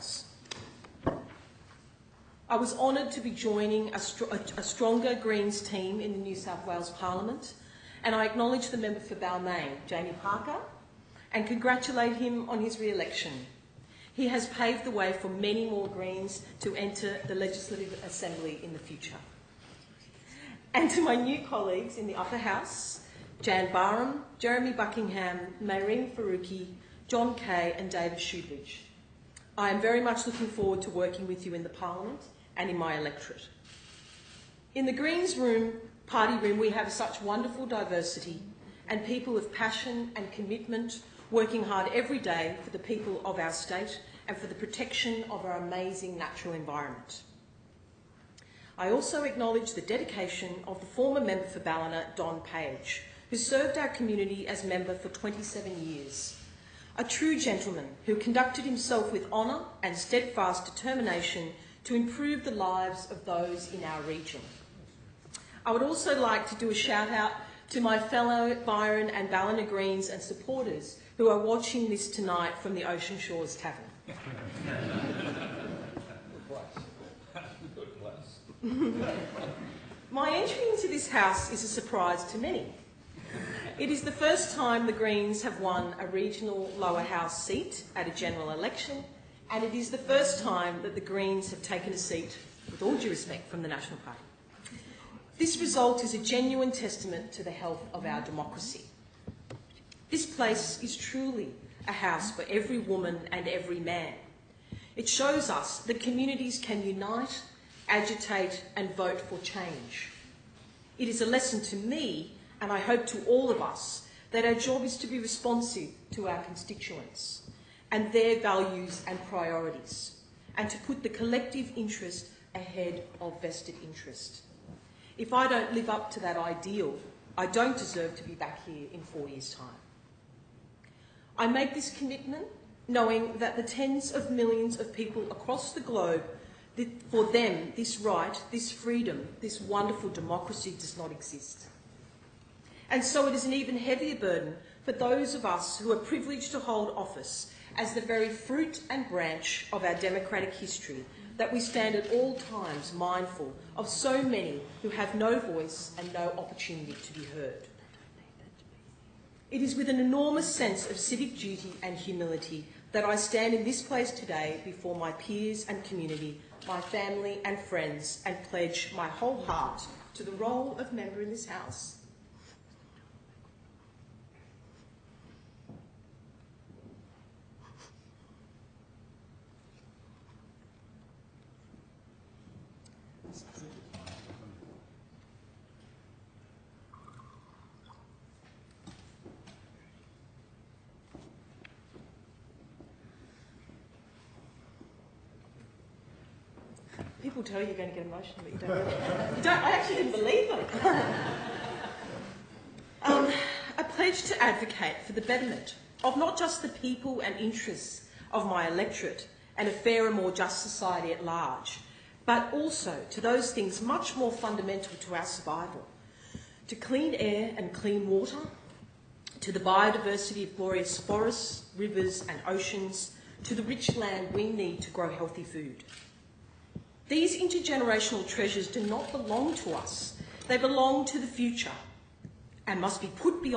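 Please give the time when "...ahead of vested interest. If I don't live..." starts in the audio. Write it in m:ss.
2:02.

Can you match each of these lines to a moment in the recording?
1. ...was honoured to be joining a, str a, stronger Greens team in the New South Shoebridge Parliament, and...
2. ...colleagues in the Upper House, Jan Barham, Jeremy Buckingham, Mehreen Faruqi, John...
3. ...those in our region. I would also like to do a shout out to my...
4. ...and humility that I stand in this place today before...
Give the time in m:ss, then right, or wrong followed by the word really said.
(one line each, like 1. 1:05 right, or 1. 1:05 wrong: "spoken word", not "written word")
1. 0:02 wrong: "Wales", not "Shoebridge"
2. 0:21 right
3. 1:03 right
4. 2:41 right.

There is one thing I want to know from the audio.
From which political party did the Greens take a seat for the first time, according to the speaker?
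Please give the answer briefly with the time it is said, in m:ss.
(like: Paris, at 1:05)
National Party, at 1:33.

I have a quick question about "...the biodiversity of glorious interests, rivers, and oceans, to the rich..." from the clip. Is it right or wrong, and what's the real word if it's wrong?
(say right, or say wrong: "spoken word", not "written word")
wrong: "forests", not "interests".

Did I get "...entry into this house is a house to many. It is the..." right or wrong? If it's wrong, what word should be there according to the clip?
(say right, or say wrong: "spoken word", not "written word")
wrong: "surprise", not "house".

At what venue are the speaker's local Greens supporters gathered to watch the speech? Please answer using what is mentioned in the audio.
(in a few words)
Ocean Shores Tavern.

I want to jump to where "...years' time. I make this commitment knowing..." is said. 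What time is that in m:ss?
2:09.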